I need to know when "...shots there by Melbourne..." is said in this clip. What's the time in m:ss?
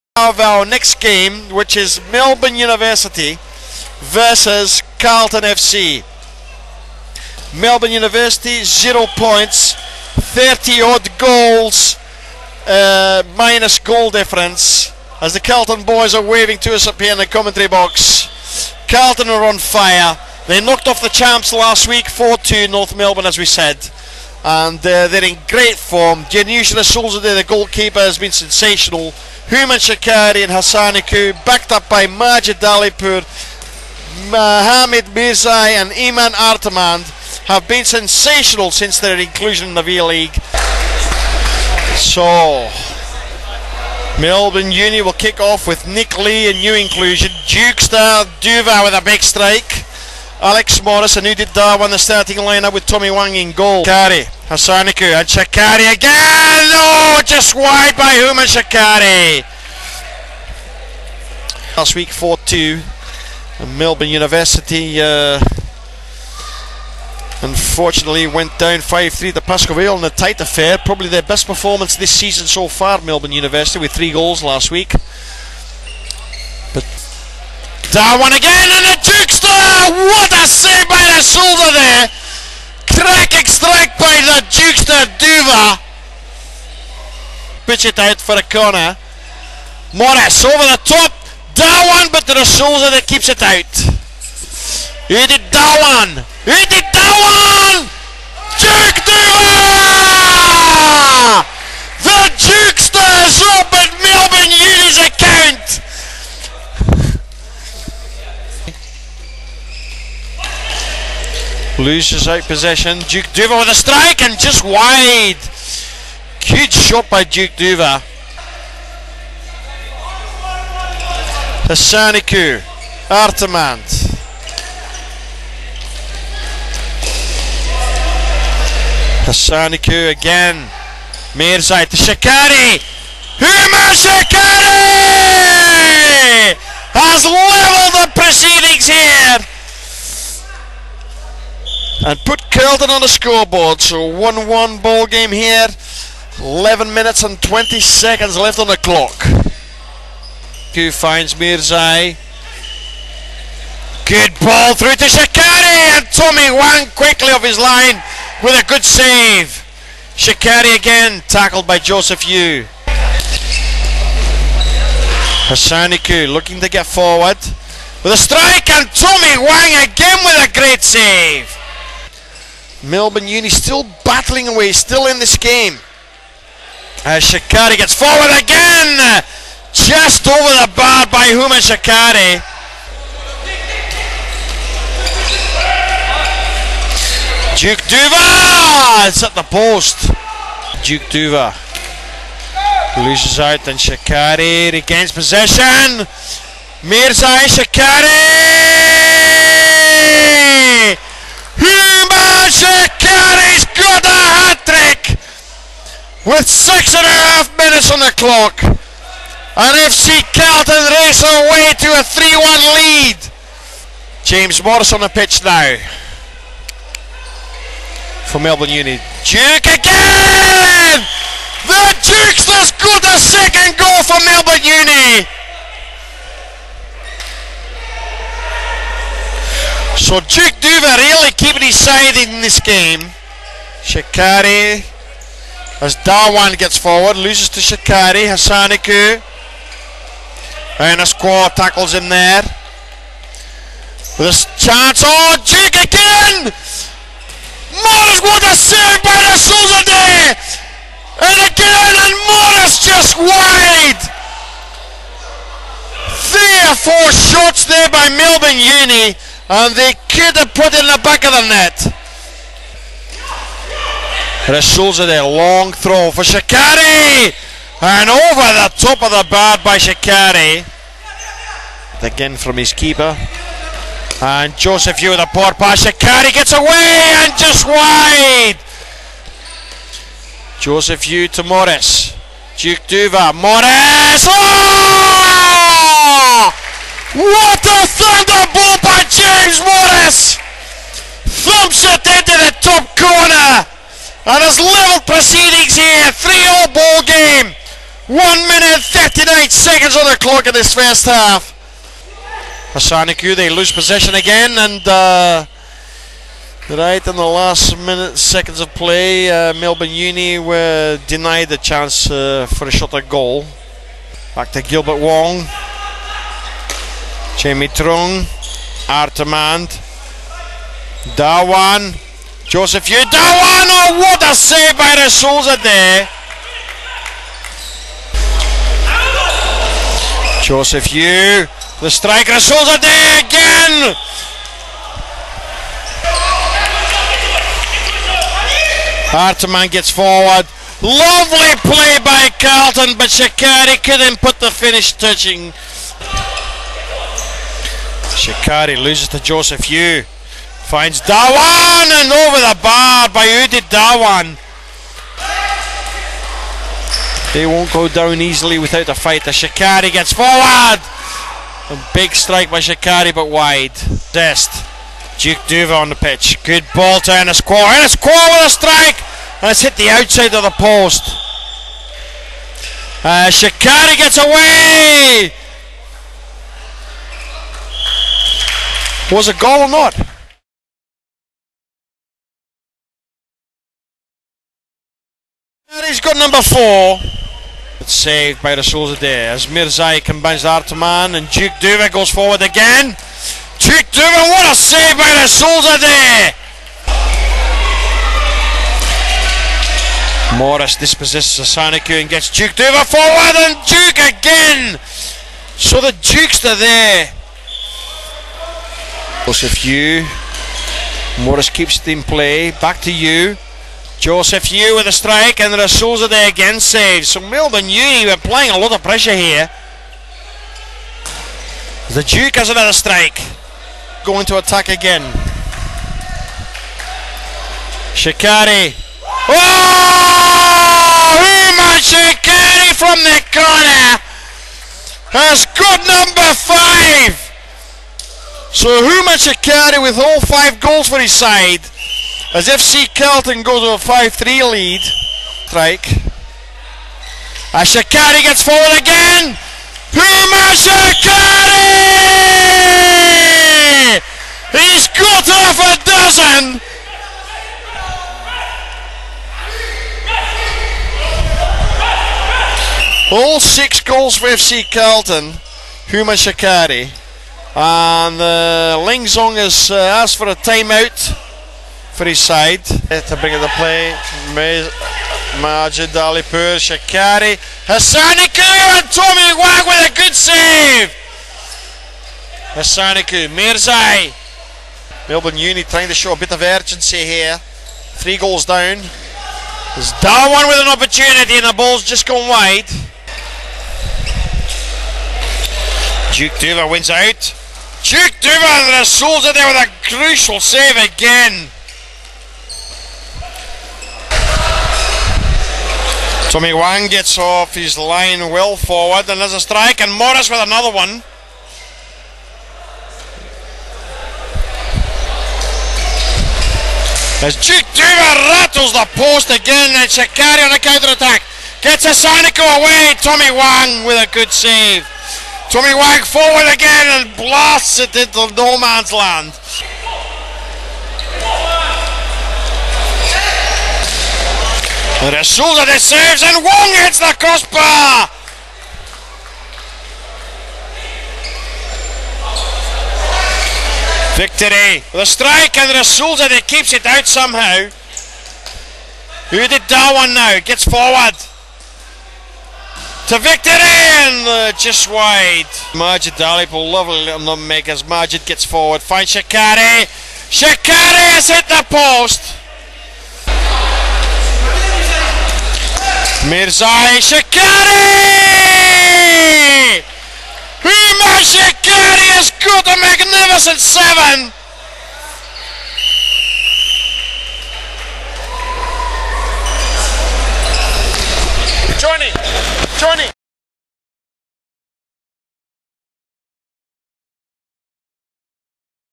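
4:17.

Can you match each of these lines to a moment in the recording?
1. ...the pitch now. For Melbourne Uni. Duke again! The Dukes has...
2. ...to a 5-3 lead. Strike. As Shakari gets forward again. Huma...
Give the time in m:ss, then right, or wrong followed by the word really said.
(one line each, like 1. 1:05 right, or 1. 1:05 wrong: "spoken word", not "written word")
1. 3:35 right
2. 7:23 right.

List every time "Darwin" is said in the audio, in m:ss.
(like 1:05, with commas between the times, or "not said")
0:51, 1:17, 3:56, 8:10.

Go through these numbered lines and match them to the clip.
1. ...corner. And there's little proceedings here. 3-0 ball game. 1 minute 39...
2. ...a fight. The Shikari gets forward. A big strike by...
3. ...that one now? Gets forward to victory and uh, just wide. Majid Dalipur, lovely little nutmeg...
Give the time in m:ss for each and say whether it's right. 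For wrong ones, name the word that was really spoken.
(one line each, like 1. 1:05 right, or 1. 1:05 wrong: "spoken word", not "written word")
1. 4:52 right
2. 5:58 right
3. 9:09 right.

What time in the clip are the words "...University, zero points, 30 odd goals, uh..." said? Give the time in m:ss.
0:07.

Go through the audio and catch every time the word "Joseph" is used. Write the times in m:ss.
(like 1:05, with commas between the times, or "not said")
2:41, 4:34, 4:40, 5:22, 5:30, 5:49, 6:49, 6:54.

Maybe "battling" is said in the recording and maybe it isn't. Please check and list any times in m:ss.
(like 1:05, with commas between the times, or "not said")
2:54.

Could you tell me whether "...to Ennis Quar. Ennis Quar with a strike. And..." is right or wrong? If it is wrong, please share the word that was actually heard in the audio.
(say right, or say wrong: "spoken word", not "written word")
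right.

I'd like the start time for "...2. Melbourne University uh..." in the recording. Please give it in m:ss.
1:02.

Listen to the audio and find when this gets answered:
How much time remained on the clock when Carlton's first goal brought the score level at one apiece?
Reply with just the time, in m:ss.
2:26.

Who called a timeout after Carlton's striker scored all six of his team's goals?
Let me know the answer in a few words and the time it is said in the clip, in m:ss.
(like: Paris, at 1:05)
Ling Zong, at 7:48.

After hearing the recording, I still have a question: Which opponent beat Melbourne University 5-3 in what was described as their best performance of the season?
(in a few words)
Pascoe Vale.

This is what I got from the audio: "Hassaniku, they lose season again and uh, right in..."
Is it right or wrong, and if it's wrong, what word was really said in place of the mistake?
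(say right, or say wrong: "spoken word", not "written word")
wrong: "possession", not "season".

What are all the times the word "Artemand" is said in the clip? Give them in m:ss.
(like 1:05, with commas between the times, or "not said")
2:03, 5:18.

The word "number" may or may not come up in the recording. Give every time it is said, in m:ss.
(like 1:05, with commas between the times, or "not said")
6:26, 7:15.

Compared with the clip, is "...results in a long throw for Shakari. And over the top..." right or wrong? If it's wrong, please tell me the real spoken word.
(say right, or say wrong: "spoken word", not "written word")
right.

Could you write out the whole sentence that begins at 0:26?
Janusz Solzade, the goalkeeper, has been sensational.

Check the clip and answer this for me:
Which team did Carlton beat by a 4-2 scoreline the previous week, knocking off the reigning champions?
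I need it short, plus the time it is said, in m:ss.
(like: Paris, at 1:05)
North Melbourne, at 0:22.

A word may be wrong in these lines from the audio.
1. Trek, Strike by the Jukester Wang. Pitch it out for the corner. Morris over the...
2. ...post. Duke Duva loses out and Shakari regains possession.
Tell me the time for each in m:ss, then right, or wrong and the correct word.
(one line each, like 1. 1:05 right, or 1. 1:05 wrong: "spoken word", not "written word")
1. 1:22 wrong: "Duva", not "Wang"
2. 3:09 right.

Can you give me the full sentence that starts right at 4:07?
Morris, what a save by the Souza there, And again, and Morris just wide!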